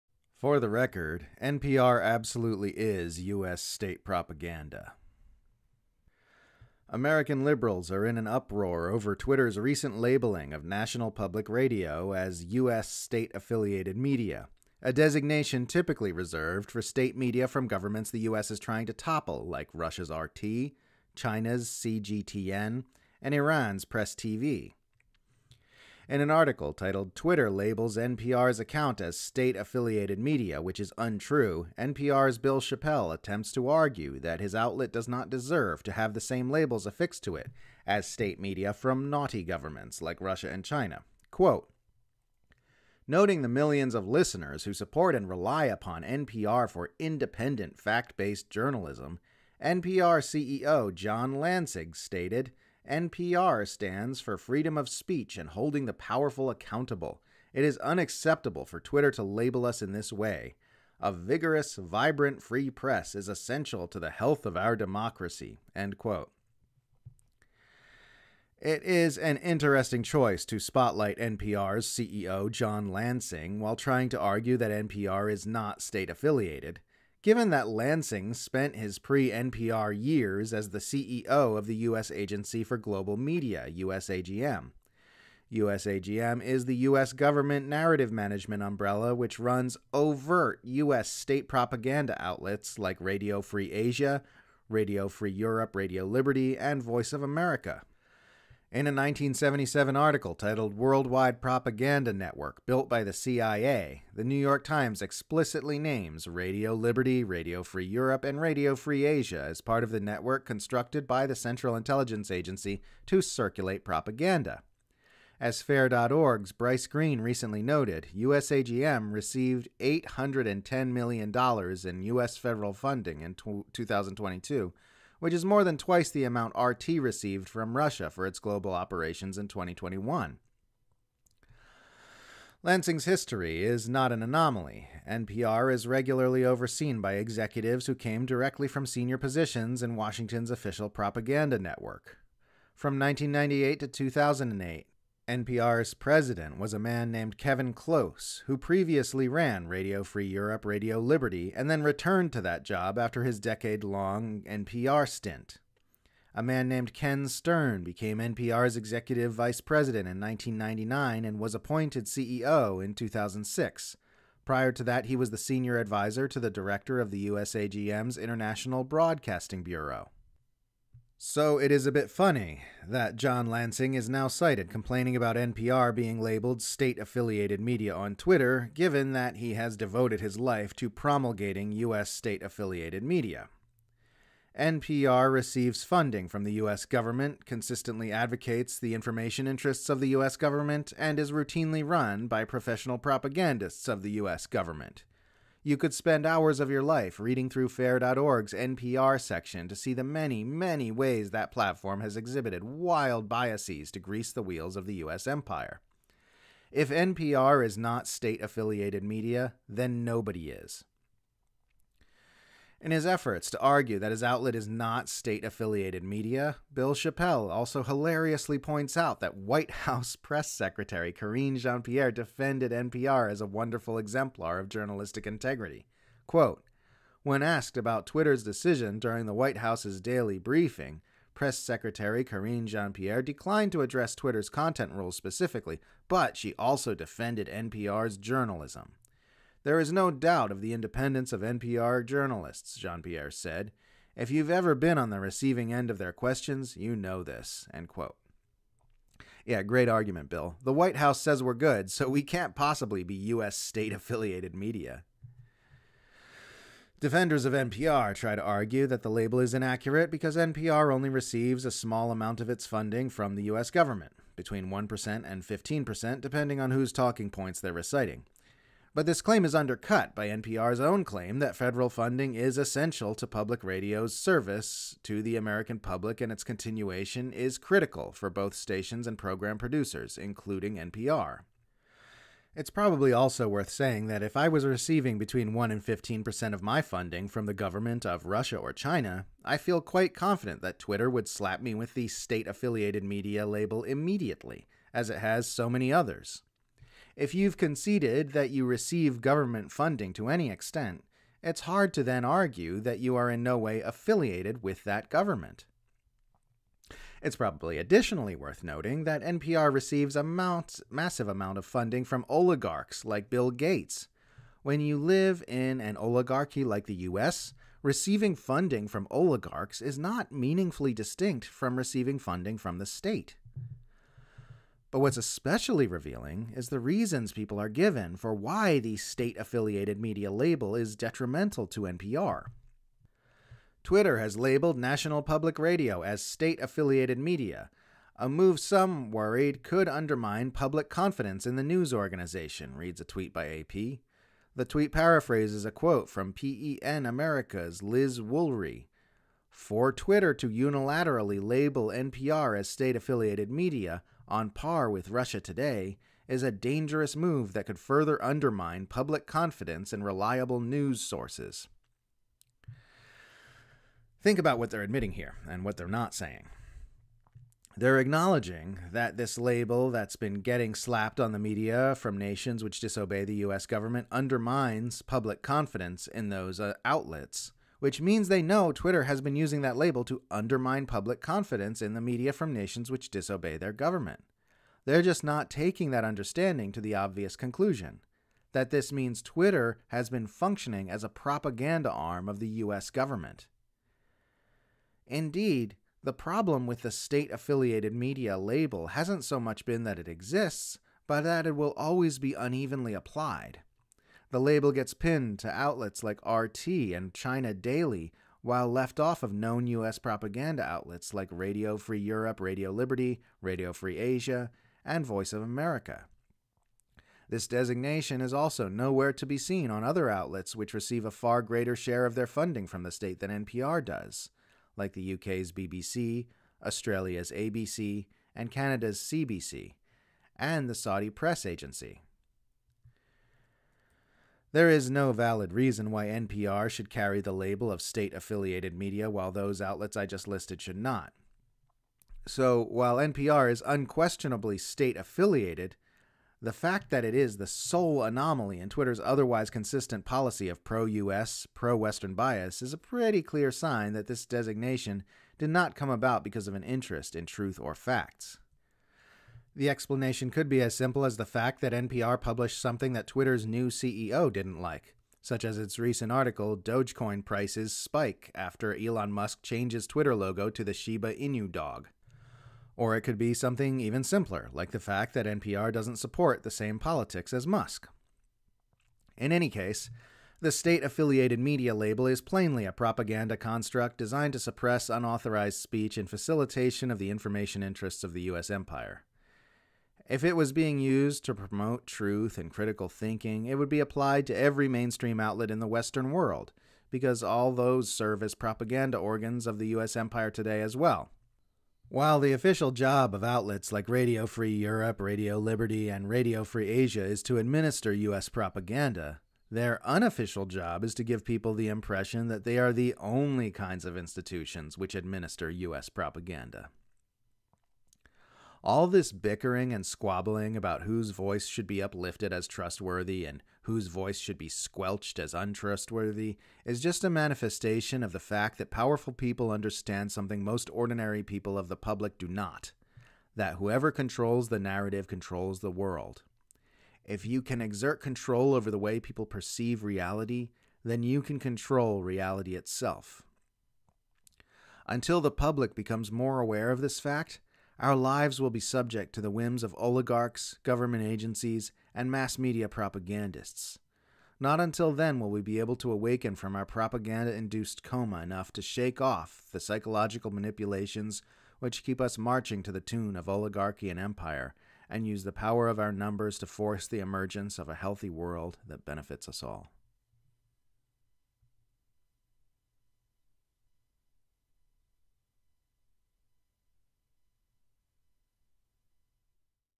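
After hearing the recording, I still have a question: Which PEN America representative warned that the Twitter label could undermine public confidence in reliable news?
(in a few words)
Liz Woolery.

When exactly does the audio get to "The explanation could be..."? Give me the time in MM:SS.
07:39.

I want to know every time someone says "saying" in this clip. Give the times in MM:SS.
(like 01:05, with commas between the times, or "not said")
04:43, 06:06.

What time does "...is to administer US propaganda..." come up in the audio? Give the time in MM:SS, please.
08:27.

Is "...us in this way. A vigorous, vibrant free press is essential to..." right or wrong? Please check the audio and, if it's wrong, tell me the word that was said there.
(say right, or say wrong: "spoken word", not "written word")
right.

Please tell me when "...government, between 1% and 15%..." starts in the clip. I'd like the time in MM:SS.
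04:23.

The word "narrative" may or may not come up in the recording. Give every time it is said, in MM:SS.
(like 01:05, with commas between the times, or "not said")
01:27, 08:54.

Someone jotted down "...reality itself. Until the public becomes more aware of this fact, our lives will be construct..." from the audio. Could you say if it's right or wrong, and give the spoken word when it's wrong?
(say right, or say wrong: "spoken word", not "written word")
wrong: "subject", not "construct".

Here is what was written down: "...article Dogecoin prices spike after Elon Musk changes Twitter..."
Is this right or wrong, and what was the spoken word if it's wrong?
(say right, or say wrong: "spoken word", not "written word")
right.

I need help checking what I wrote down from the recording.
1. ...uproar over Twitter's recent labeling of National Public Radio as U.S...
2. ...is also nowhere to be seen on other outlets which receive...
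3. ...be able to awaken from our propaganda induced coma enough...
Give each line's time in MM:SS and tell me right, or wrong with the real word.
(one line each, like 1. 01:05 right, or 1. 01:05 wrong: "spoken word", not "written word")
1. 00:08 right
2. 06:58 right
3. 09:15 right.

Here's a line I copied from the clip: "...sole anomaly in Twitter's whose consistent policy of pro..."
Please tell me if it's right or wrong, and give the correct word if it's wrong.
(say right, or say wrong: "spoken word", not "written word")
wrong: "otherwise", not "whose".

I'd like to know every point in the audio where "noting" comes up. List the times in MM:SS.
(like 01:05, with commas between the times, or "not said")
00:43, 05:08.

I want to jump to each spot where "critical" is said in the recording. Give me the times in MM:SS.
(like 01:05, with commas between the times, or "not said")
04:37, 08:12.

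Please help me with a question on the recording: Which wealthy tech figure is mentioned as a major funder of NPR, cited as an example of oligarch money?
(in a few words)
Bill Gates.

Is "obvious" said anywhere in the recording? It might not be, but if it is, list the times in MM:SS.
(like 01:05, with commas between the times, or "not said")
06:26.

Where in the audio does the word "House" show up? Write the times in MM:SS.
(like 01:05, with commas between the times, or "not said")
03:39, 03:49, 04:10.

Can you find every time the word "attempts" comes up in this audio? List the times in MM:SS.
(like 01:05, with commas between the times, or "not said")
00:33.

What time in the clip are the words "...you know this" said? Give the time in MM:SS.
04:06.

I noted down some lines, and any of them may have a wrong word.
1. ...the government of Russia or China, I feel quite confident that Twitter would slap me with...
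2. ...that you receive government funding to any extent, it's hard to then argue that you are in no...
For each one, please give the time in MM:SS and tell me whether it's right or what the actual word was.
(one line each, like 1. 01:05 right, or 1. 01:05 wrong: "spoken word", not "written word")
1. 04:47 right
2. 04:58 right.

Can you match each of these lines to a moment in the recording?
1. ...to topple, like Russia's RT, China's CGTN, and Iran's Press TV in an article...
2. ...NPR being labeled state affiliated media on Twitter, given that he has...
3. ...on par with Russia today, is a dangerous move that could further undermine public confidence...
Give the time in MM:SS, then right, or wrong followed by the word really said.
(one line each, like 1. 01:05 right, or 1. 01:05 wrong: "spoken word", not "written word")
1. 00:18 right
2. 02:55 right
3. 05:54 right.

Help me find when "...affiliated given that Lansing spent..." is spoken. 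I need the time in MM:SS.
01:16.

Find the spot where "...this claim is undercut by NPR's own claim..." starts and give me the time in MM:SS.
04:29.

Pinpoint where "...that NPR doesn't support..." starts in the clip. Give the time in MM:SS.
07:55.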